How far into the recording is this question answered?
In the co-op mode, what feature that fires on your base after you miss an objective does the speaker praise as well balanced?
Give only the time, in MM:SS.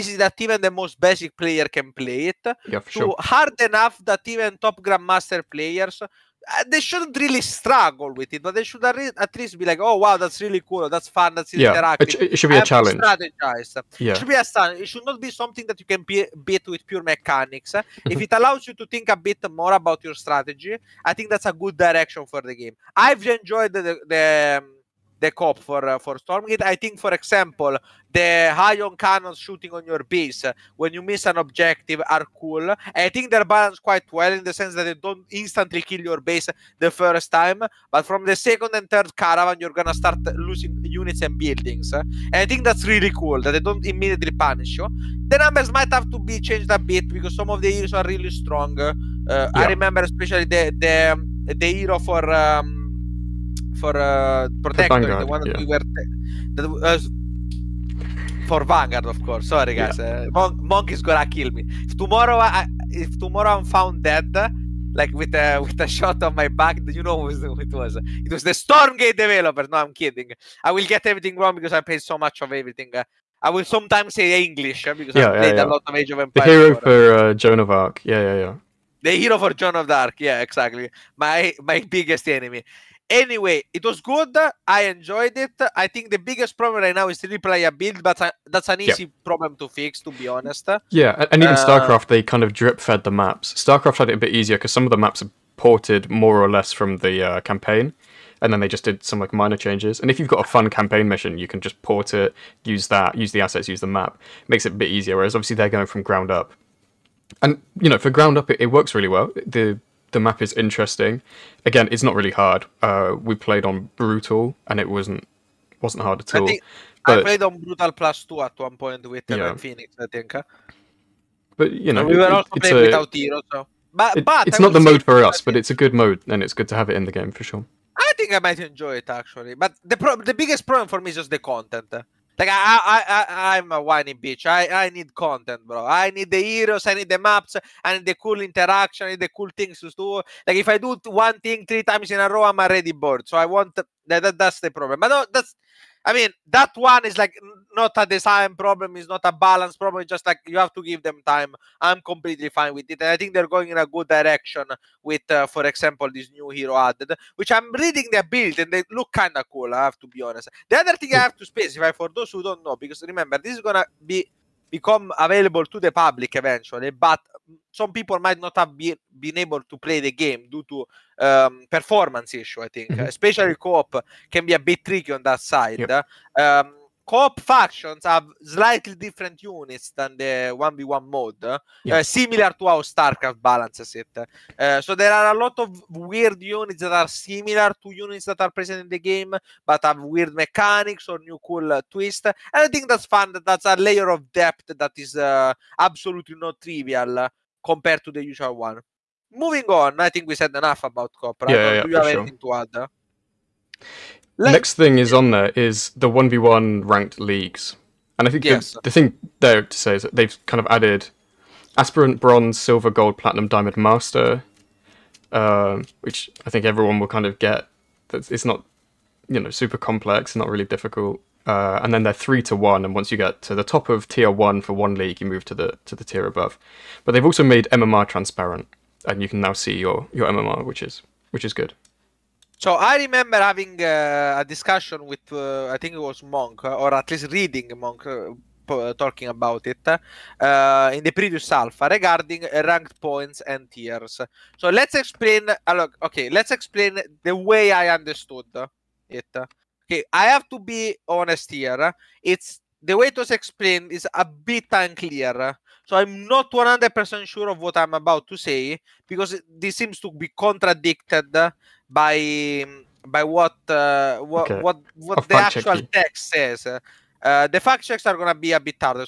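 00:28.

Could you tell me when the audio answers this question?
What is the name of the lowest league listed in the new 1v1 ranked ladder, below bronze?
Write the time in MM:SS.
03:31.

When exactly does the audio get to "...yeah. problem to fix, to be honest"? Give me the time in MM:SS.
01:29.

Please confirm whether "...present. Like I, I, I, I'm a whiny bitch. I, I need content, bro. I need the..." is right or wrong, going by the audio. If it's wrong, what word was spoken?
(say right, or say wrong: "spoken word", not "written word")
wrong: "content", not "present".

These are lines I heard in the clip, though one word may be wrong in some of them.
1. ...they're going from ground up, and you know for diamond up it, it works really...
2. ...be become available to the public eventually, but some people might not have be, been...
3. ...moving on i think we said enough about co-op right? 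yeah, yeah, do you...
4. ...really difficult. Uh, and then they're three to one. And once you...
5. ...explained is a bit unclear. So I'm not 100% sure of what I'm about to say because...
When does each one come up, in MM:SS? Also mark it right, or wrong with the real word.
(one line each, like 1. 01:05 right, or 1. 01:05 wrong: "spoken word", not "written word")
1. 01:45 wrong: "ground", not "diamond"
2. 02:44 right
3. 03:19 right
4. 03:40 right
5. 04:13 right.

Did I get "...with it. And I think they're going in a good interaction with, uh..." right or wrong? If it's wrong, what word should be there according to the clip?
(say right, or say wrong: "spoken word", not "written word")
wrong: "direction", not "interaction".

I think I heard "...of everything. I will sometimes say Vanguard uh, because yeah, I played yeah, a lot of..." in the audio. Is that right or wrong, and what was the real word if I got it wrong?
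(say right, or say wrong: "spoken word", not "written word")
wrong: "English", not "Vanguard".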